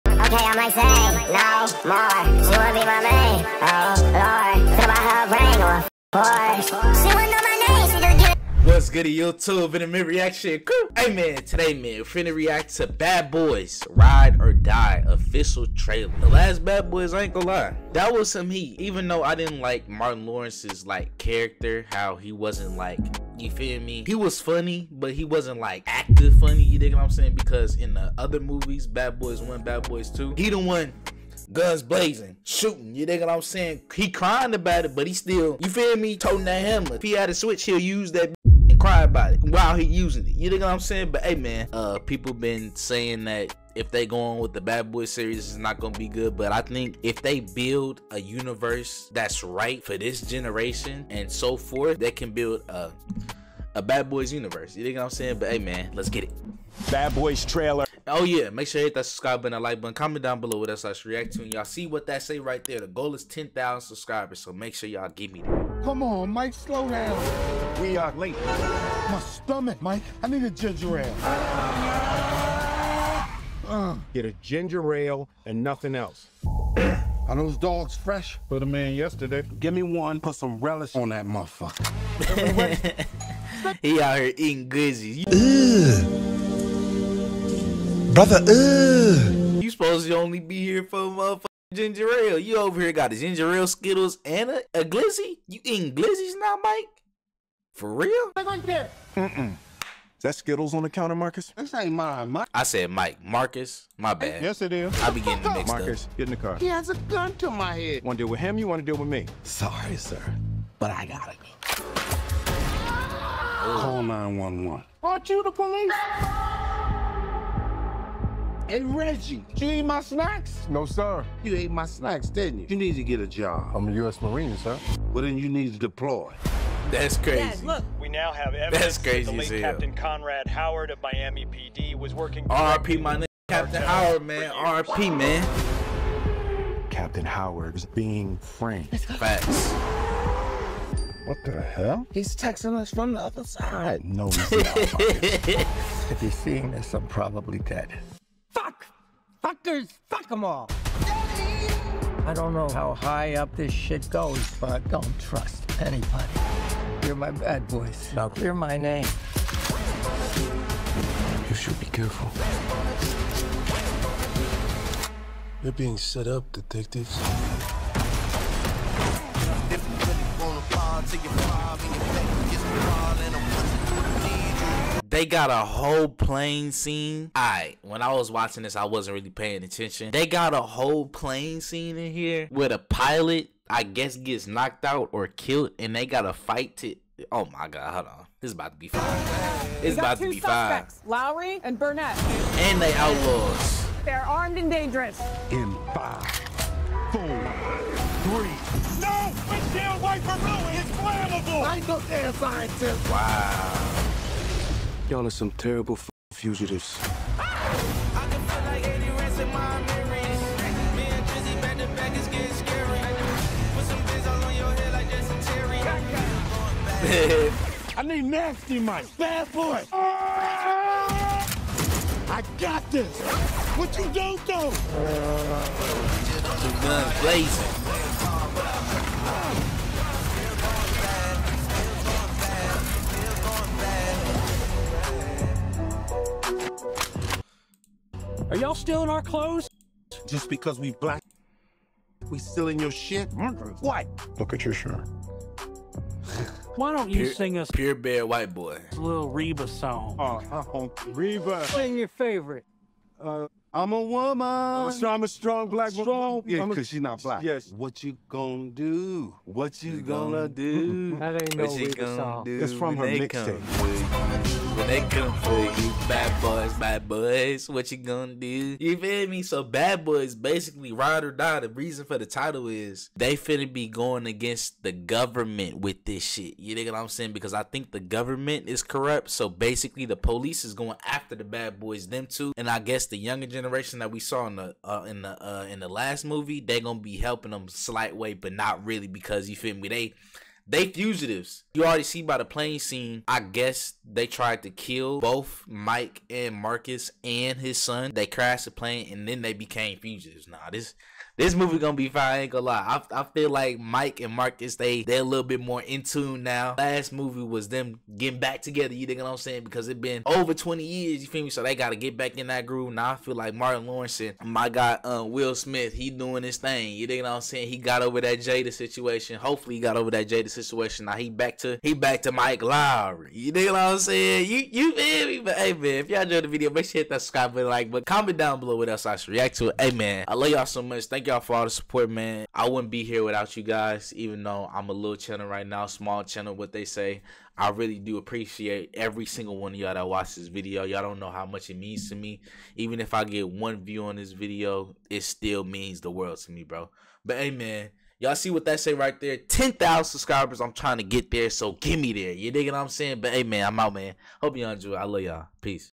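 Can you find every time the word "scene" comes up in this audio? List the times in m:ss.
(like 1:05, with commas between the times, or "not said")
2:56, 3:01, 4:52.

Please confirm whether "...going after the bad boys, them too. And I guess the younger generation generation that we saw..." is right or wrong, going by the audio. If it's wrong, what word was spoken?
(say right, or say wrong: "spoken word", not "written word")
right.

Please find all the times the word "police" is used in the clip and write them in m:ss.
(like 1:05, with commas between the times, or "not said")
1:55, 4:40.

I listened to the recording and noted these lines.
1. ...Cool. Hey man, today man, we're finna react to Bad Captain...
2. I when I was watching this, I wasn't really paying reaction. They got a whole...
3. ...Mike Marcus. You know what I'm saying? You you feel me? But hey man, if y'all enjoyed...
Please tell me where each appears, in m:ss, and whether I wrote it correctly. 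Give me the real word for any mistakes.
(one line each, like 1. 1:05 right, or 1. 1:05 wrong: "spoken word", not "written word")
1. 0:10 wrong: "Boys", not "Captain"
2. 2:57 wrong: "attention", not "reaction"
3. 5:22 wrong: "Lowrey", not "Marcus".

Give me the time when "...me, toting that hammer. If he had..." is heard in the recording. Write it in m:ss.
0:35.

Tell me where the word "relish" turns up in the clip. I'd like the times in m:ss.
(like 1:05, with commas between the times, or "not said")
1:20.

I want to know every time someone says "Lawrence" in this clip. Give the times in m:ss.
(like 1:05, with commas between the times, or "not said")
0:20, 5:13.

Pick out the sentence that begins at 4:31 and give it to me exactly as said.
The reason for the title is they finna be going against the government with this shit.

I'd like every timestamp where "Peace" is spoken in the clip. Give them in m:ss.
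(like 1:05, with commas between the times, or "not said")
5:55.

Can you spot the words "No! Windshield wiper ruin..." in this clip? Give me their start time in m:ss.
3:19.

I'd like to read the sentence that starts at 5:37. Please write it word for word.
I really do appreciate every single one of y'all that watch this video.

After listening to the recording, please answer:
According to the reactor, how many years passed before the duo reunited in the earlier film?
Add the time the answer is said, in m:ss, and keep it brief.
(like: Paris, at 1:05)
over 20 years, at 5:10.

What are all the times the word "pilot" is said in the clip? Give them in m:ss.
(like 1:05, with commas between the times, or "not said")
3:02.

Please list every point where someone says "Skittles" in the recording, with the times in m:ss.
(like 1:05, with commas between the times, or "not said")
1:33, 1:40.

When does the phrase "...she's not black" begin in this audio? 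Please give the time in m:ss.
4:16.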